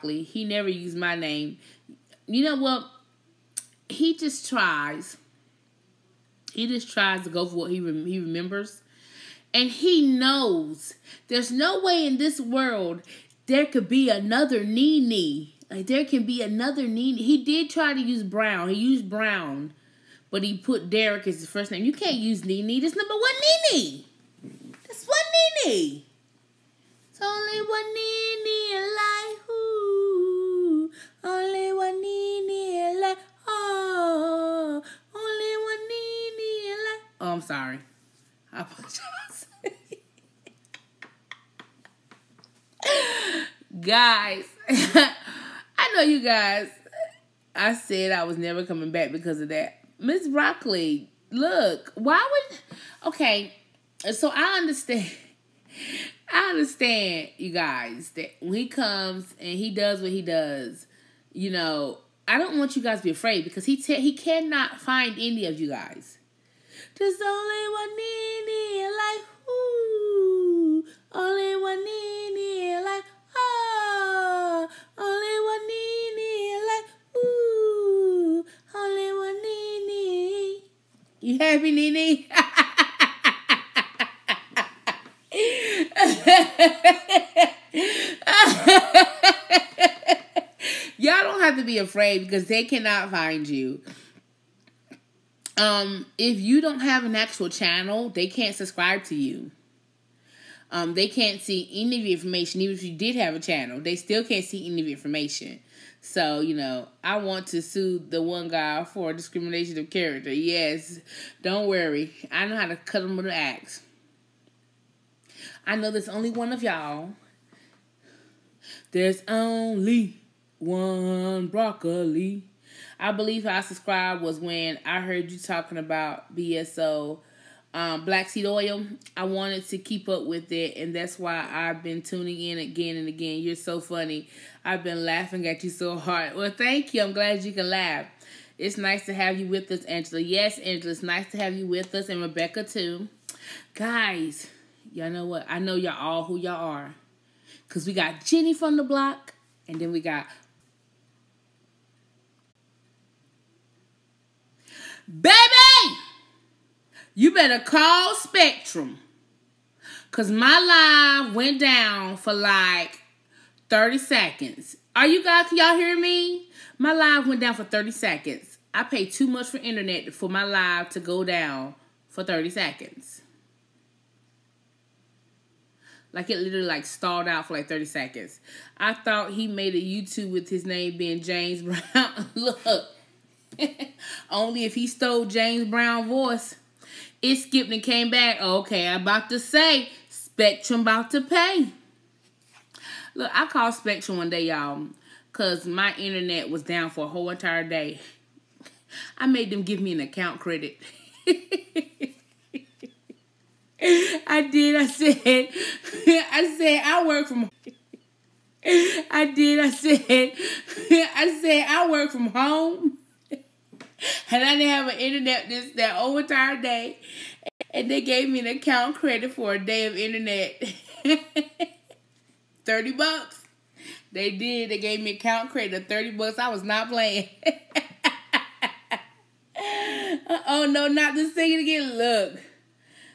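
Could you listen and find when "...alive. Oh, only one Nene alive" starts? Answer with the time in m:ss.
0:32.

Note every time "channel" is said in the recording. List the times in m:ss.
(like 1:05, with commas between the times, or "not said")
1:37, 1:43.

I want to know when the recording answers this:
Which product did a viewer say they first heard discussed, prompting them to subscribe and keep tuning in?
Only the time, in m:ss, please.
2:08.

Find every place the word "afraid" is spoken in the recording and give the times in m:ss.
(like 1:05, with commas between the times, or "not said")
1:03, 1:31.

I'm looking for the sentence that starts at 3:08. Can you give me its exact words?
Okay, I'm about to say Spectrum about to pay.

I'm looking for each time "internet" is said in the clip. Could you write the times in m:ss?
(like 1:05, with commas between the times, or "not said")
2:49, 3:15, 3:34, 3:39.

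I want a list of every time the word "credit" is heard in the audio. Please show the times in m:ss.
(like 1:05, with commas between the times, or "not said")
3:20, 3:38, 3:45.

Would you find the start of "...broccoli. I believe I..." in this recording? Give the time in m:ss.
2:01.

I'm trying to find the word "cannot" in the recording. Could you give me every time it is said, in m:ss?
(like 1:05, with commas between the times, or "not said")
1:04, 1:32.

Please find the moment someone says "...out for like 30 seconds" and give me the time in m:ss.
2:57.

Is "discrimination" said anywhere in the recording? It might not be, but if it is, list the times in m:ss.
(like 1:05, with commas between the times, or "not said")
1:49.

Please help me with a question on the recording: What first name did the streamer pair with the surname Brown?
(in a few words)
Derek.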